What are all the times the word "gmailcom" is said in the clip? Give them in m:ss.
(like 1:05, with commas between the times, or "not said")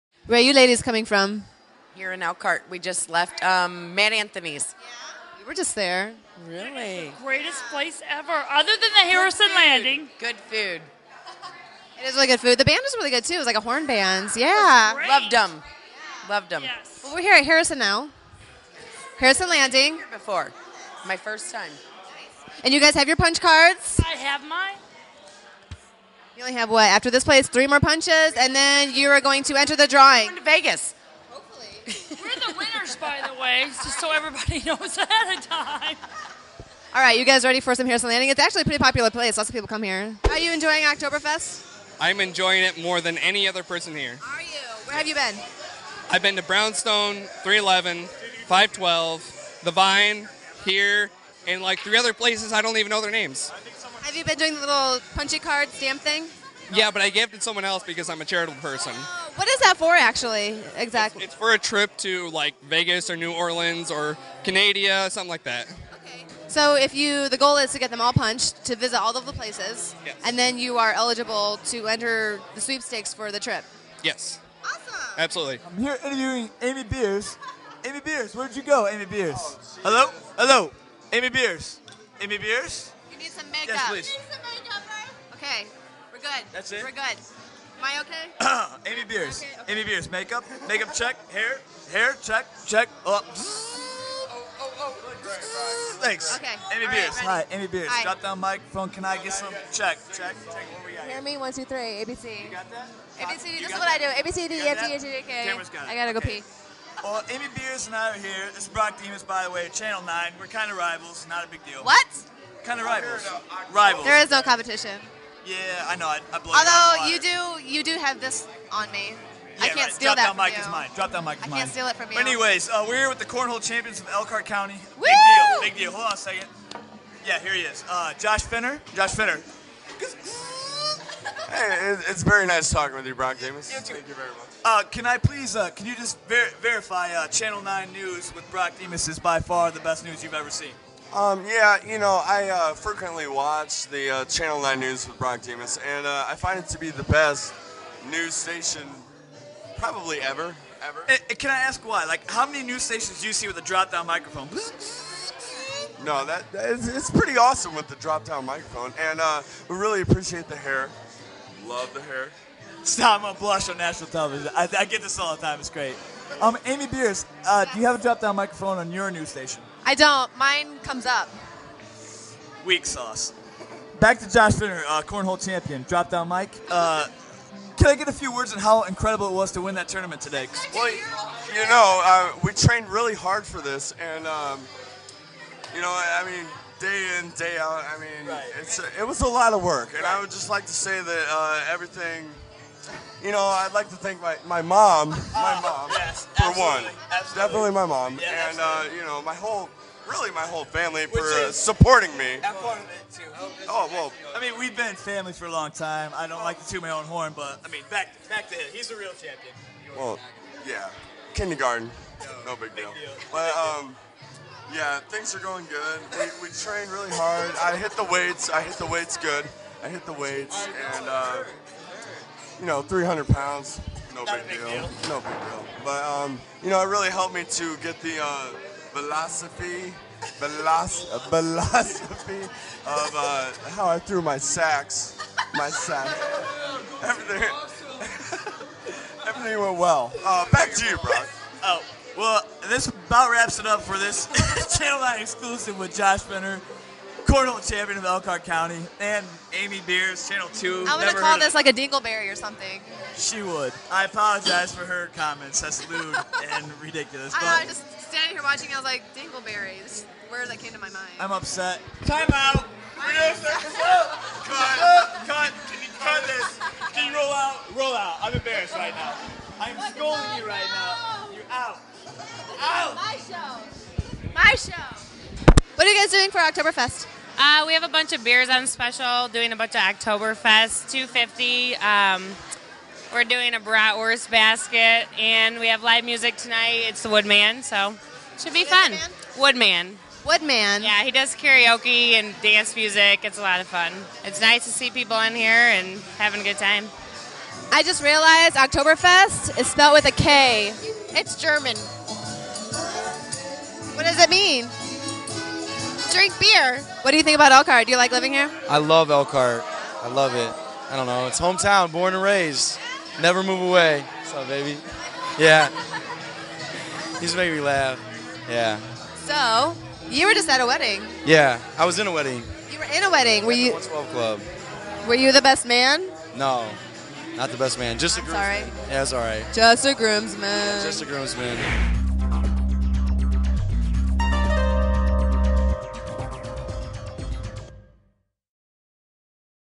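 not said.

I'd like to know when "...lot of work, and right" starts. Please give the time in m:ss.
3:09.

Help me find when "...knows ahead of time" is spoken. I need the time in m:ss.
0:34.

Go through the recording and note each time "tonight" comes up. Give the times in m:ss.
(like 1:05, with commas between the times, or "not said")
4:46.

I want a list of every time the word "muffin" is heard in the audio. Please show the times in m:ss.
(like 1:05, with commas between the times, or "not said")
not said.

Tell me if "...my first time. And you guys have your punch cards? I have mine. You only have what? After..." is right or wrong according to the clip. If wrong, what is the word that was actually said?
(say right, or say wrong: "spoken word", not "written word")
right.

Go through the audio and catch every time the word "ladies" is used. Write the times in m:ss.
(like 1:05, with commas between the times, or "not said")
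0:00.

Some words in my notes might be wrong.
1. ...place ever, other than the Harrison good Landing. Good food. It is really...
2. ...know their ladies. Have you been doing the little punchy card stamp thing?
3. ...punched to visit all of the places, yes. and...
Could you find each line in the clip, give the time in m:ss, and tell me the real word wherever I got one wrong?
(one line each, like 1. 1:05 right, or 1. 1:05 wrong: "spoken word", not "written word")
1. 0:07 right
2. 0:52 wrong: "names", not "ladies"
3. 1:08 right.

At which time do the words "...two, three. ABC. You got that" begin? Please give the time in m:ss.
1:41.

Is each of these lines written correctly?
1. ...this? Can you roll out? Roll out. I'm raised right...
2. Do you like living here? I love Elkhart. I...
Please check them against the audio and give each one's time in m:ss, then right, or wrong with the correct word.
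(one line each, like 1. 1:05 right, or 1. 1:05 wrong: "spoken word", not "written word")
1. 4:26 wrong: "embarrassed", not "raised"
2. 5:07 right.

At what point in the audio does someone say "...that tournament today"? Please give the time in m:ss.
2:59.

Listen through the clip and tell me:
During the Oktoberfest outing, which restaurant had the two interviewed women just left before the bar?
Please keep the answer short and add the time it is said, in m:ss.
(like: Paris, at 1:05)
Matt Anthony's, at 0:03.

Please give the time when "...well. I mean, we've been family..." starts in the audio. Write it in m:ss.
3:23.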